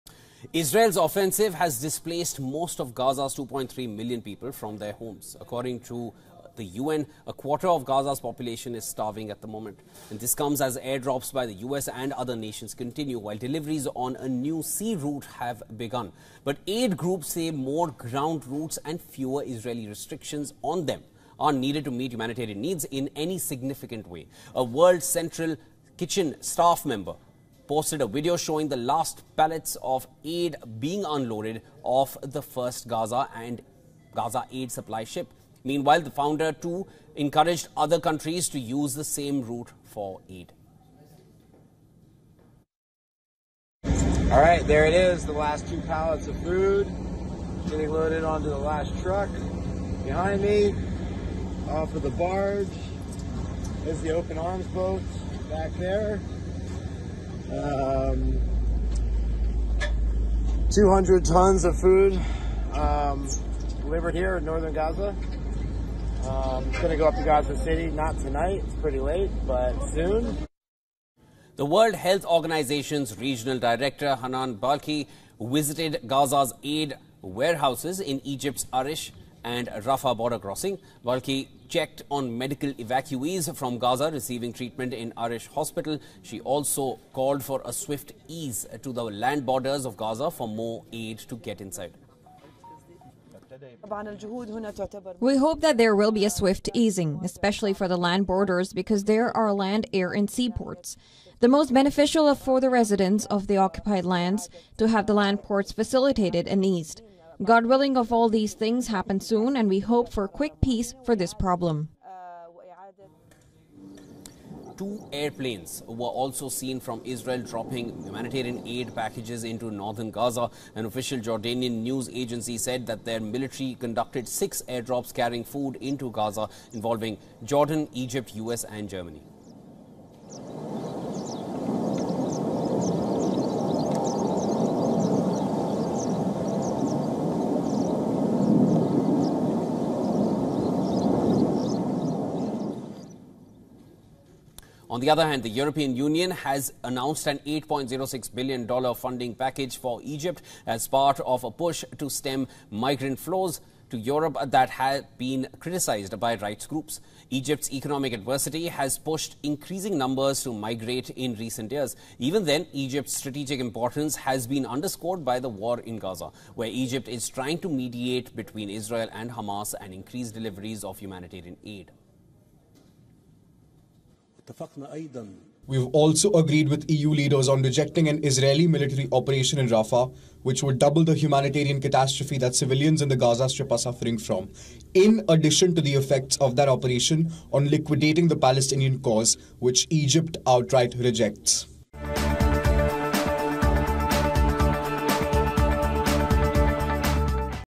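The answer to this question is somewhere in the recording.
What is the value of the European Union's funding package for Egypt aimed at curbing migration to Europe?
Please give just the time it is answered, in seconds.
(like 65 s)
147 s.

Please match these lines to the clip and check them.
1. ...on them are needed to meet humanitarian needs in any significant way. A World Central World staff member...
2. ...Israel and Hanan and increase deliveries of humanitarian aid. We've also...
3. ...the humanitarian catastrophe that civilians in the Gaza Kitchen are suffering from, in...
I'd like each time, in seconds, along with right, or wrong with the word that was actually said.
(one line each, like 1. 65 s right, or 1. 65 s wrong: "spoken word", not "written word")
1. 20 s wrong: "Kitchen", not "World"
2. 168 s wrong: "Hamas", not "Hanan"
3. 181 s wrong: "Strip", not "Kitchen".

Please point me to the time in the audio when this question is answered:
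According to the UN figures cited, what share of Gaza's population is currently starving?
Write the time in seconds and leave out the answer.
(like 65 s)
7 s.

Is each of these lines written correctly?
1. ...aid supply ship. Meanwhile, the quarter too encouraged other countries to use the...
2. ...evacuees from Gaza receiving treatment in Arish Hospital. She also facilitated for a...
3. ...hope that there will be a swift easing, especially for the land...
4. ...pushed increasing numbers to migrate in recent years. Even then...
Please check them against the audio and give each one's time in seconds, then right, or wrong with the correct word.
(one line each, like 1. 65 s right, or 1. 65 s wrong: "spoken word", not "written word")
1. 34 s wrong: "founder", not "quarter"
2. 82 s wrong: "called", not "facilitated"
3. 95 s right
4. 158 s right.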